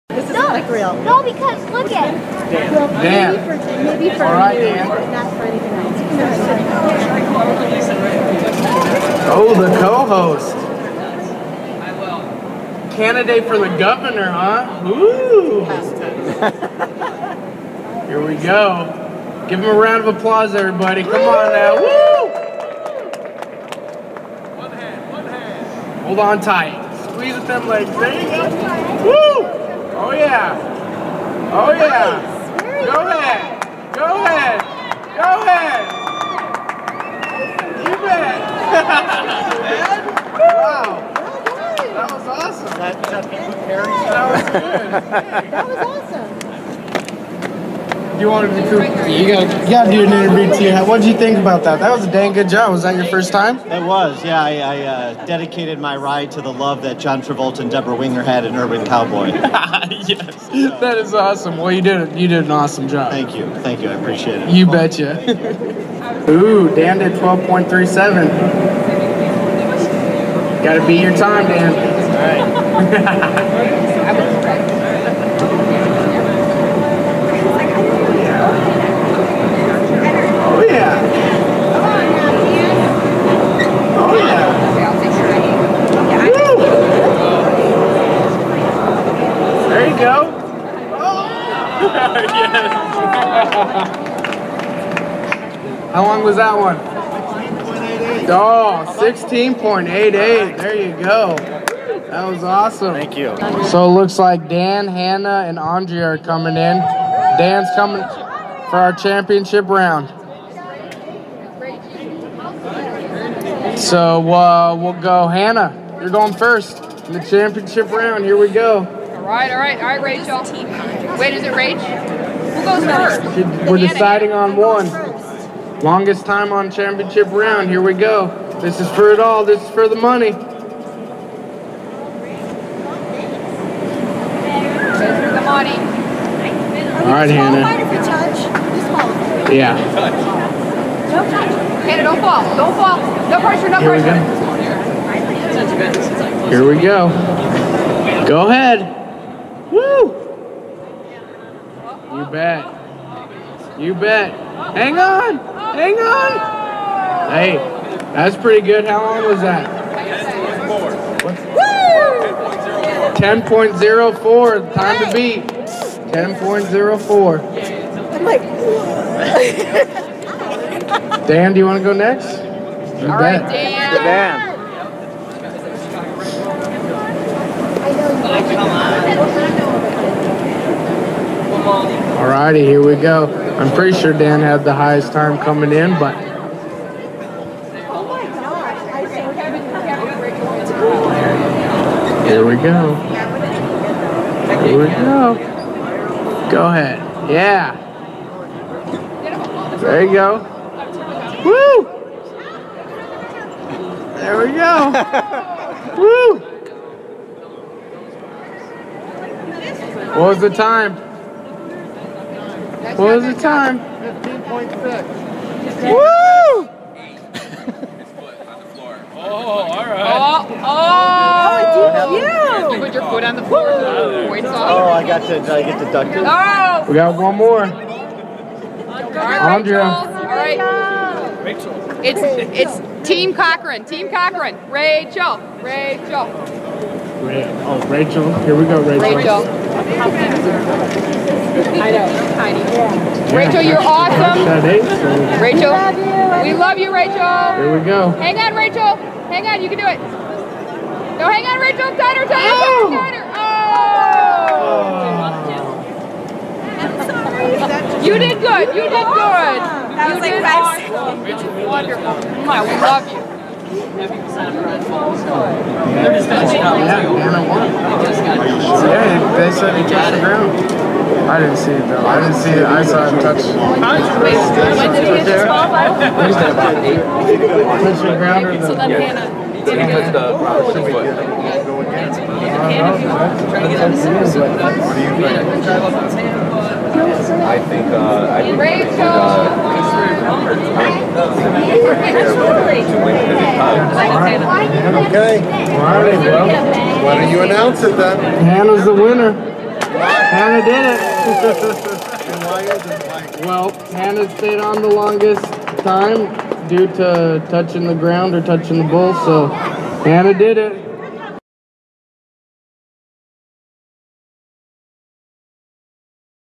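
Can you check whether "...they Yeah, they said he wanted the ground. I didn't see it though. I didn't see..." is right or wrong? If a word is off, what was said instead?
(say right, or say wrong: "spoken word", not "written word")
wrong: "touched", not "wanted".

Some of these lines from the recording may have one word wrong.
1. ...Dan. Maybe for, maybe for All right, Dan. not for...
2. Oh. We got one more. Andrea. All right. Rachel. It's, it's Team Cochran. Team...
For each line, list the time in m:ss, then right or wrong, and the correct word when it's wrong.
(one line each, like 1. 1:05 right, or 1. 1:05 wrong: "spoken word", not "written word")
1. 0:02 right
2. 3:46 right.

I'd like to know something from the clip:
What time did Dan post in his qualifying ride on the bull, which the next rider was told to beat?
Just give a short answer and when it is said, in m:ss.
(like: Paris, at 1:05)
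12.37, at 1:07.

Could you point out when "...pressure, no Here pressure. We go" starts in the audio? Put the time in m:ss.
2:23.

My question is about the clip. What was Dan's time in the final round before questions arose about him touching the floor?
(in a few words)
15.6.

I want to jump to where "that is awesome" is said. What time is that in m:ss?
1:00.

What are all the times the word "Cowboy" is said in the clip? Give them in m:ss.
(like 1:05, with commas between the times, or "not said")
0:58.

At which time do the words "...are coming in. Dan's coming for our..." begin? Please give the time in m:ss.
1:46.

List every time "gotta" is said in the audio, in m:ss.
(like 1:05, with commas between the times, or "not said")
0:49, 1:10.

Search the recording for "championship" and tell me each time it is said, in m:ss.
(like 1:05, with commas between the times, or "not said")
1:48, 1:57, 2:06.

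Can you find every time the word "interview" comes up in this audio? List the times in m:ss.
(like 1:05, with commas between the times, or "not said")
0:50.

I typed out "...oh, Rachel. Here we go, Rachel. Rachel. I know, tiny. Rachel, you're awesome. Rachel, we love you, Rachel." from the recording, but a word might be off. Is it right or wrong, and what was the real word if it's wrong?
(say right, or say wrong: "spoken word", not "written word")
right.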